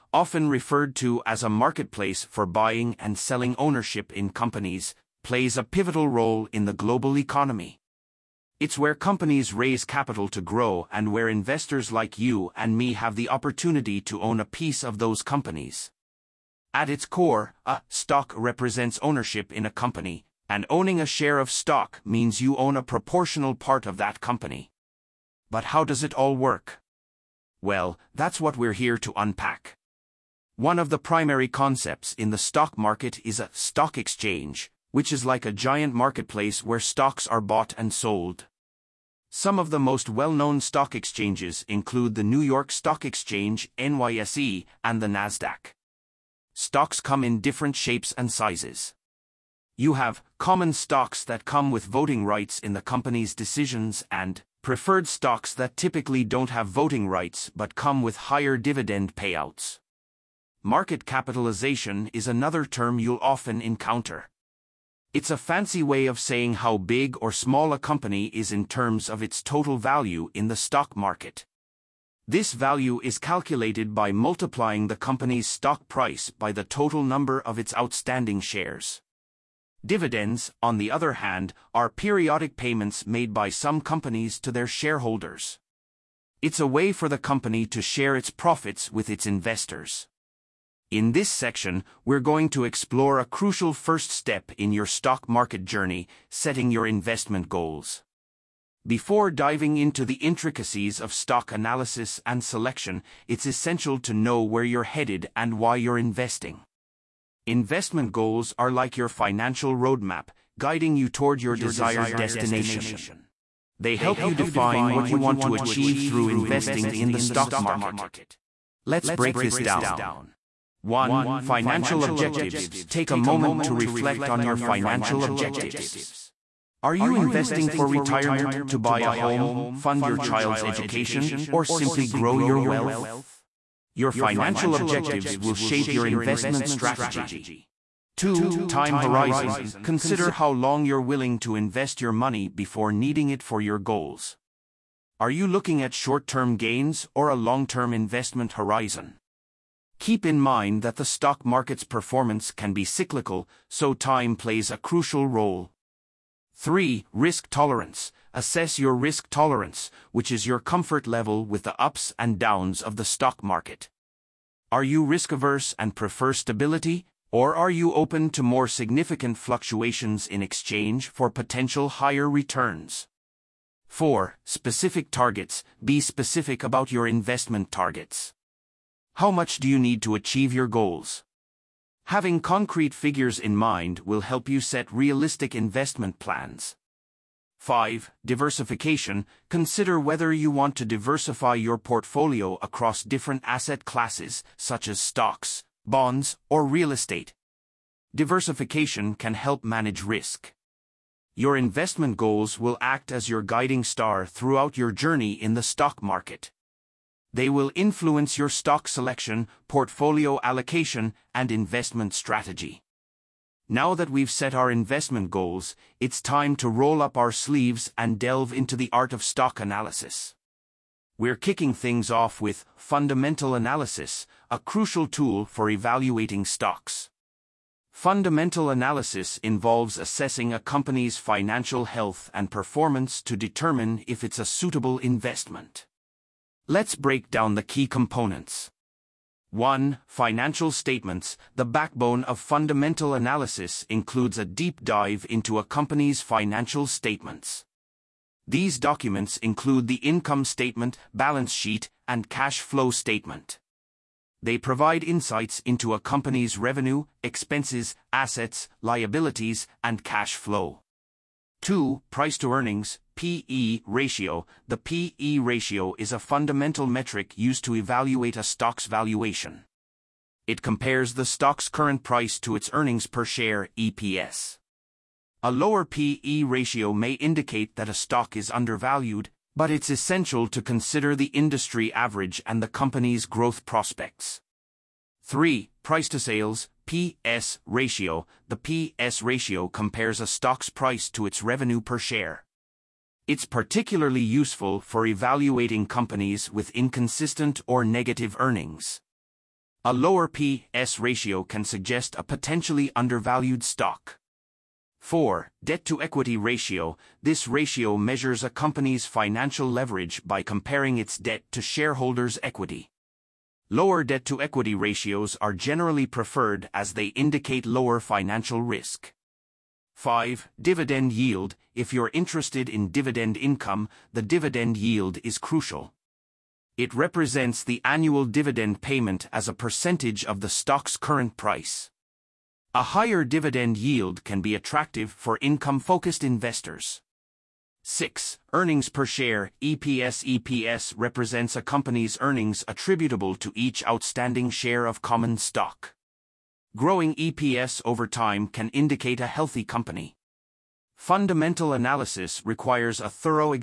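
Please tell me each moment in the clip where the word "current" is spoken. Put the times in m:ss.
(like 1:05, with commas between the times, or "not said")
4:31, 5:30.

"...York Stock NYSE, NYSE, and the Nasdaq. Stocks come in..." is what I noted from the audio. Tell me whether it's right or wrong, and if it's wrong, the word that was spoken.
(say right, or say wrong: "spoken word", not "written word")
wrong: "Exchange", not "NYSE".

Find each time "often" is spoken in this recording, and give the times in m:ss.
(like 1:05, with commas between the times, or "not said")
0:00, 1:03.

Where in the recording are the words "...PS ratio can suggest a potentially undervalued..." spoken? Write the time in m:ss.
5:00.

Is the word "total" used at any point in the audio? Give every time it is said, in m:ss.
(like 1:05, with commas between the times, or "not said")
1:09, 1:16.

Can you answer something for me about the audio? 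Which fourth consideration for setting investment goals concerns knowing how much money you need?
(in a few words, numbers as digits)
Specific targets.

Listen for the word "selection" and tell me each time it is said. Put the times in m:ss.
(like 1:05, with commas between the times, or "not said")
1:42, 3:28.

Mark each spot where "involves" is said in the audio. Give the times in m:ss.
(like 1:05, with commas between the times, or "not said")
3:49.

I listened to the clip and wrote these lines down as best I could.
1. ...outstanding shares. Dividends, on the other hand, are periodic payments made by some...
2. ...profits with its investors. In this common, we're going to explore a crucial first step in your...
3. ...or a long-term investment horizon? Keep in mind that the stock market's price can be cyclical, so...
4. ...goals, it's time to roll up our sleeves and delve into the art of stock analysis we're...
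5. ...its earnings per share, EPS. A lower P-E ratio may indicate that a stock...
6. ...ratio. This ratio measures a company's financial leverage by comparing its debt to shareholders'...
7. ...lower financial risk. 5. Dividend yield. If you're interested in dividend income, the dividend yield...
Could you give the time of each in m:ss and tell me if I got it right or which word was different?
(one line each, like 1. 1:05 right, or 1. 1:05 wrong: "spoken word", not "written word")
1. 1:17 right
2. 1:28 wrong: "section", not "common"
3. 2:27 wrong: "performance", not "price"
4. 3:35 right
5. 4:32 right
6. 5:06 right
7. 5:17 right.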